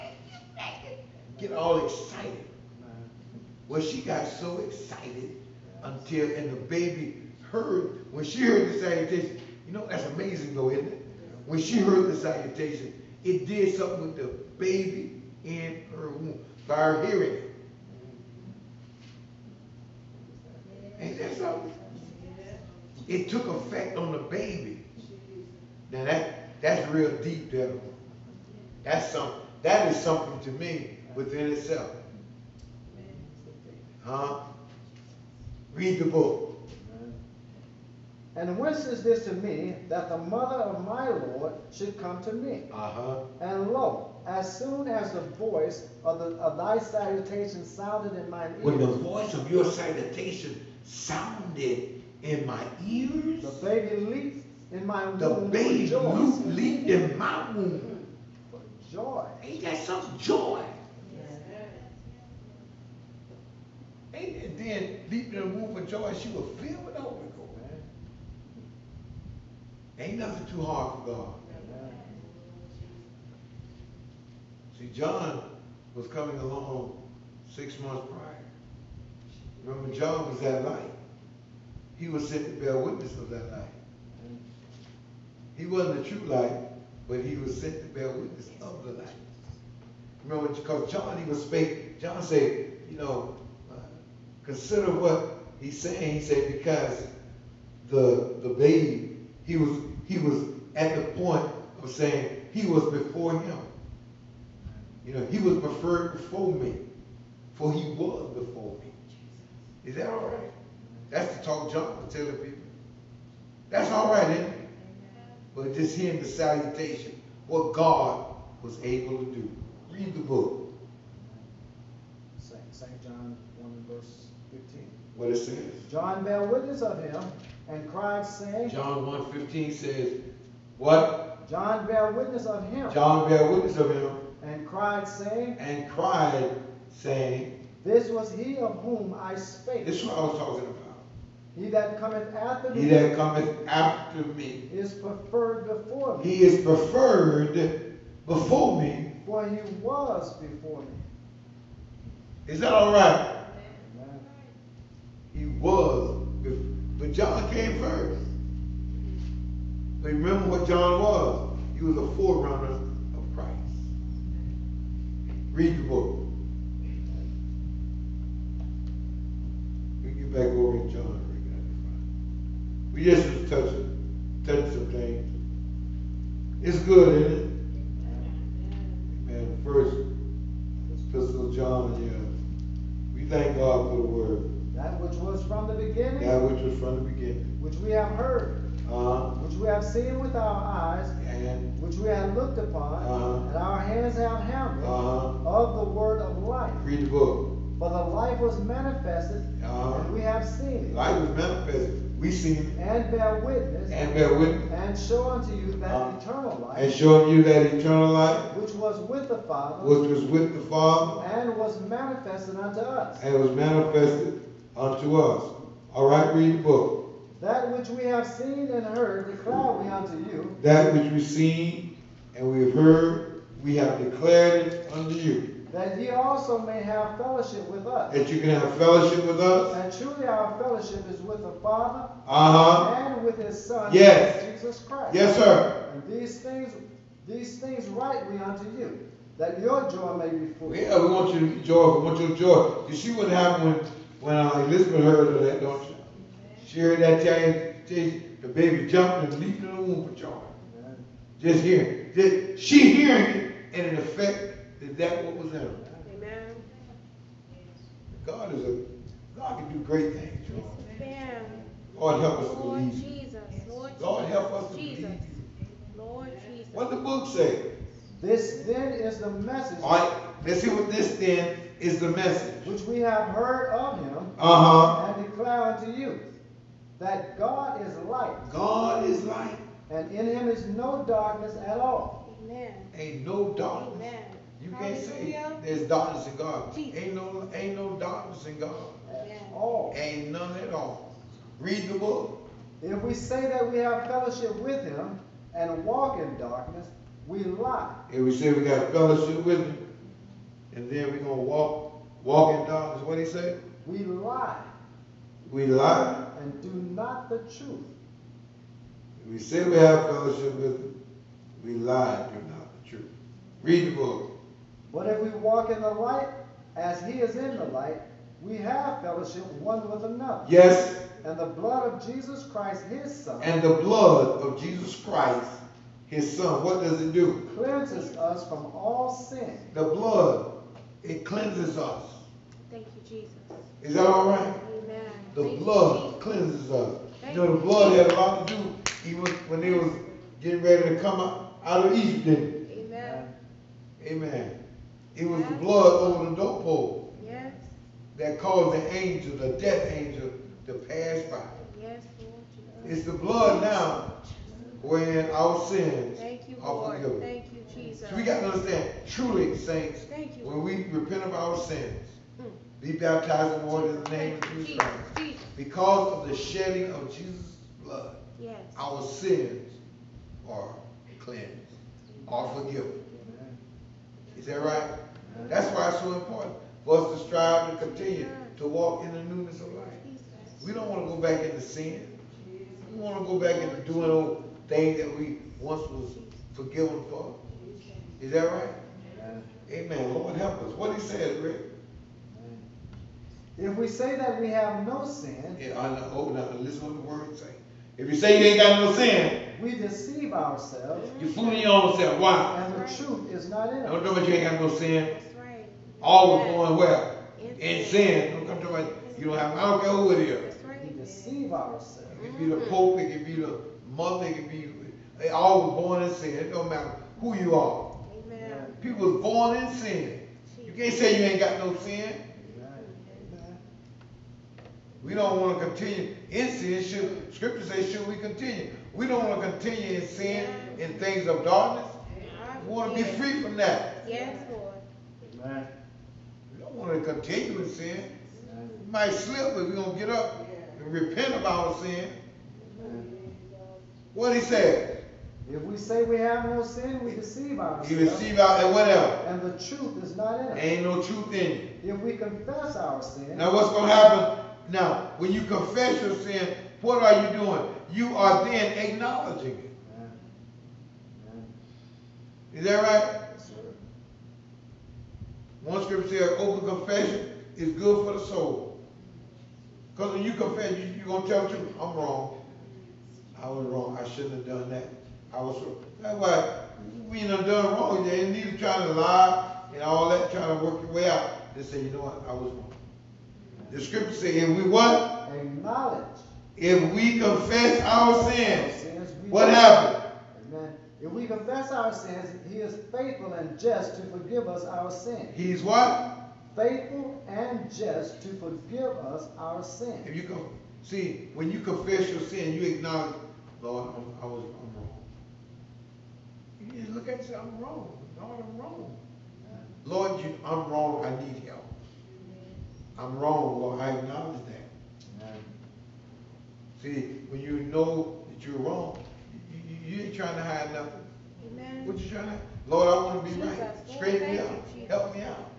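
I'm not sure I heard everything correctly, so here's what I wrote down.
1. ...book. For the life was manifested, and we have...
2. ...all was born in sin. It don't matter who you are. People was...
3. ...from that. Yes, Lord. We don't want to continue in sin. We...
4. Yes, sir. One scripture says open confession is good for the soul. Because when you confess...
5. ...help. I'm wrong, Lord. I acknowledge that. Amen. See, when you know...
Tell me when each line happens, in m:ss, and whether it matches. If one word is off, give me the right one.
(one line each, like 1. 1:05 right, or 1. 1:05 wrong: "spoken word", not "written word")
1. 3:17 right
2. 6:55 right
3. 7:13 right
4. 7:43 right
5. 8:31 right.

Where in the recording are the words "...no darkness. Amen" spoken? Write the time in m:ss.
4:43.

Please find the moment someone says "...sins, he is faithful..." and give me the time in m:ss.
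8:11.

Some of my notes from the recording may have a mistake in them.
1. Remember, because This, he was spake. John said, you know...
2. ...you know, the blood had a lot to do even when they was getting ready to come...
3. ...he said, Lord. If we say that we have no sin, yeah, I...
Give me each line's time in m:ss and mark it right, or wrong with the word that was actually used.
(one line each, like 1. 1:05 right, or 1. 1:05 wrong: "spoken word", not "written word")
1. 1:30 wrong: "John", not "This"
2. 5:37 right
3. 6:30 wrong: "Rick", not "Lord".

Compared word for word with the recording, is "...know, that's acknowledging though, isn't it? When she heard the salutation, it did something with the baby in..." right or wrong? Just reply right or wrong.
wrong.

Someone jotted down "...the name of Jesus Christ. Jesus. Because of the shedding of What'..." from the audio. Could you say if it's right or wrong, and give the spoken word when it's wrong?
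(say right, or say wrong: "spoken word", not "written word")
wrong: "Jesus", not "What".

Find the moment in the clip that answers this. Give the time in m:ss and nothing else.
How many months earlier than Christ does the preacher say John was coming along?
1:17.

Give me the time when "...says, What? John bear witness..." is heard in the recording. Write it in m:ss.
2:09.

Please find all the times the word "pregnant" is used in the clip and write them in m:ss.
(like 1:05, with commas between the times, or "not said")
0:00.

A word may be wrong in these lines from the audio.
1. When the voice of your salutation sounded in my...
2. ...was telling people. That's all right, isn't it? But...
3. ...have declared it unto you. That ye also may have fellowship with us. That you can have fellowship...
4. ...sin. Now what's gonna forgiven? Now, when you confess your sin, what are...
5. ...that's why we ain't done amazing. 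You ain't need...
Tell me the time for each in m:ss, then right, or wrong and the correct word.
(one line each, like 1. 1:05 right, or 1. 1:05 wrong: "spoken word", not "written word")
1. 0:48 right
2. 1:52 right
3. 3:43 right
4. 7:33 wrong: "happen", not "forgiven"
5. 7:55 wrong: "wrong", not "amazing".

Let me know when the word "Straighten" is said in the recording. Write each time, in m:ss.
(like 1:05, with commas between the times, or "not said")
8:43.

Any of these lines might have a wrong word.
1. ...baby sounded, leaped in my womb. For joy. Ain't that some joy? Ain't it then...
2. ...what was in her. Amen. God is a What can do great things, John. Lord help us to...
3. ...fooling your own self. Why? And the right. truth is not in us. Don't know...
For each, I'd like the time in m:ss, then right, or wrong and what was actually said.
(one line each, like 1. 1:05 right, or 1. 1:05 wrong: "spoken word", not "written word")
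1. 0:55 wrong: "leaped", not "sounded"
2. 4:15 wrong: "God", not "What"
3. 6:41 right.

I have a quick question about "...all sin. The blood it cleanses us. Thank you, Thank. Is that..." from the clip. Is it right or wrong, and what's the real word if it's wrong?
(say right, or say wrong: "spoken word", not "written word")
wrong: "Jesus", not "Thank".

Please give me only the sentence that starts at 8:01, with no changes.
They say, you know what, I was wrong.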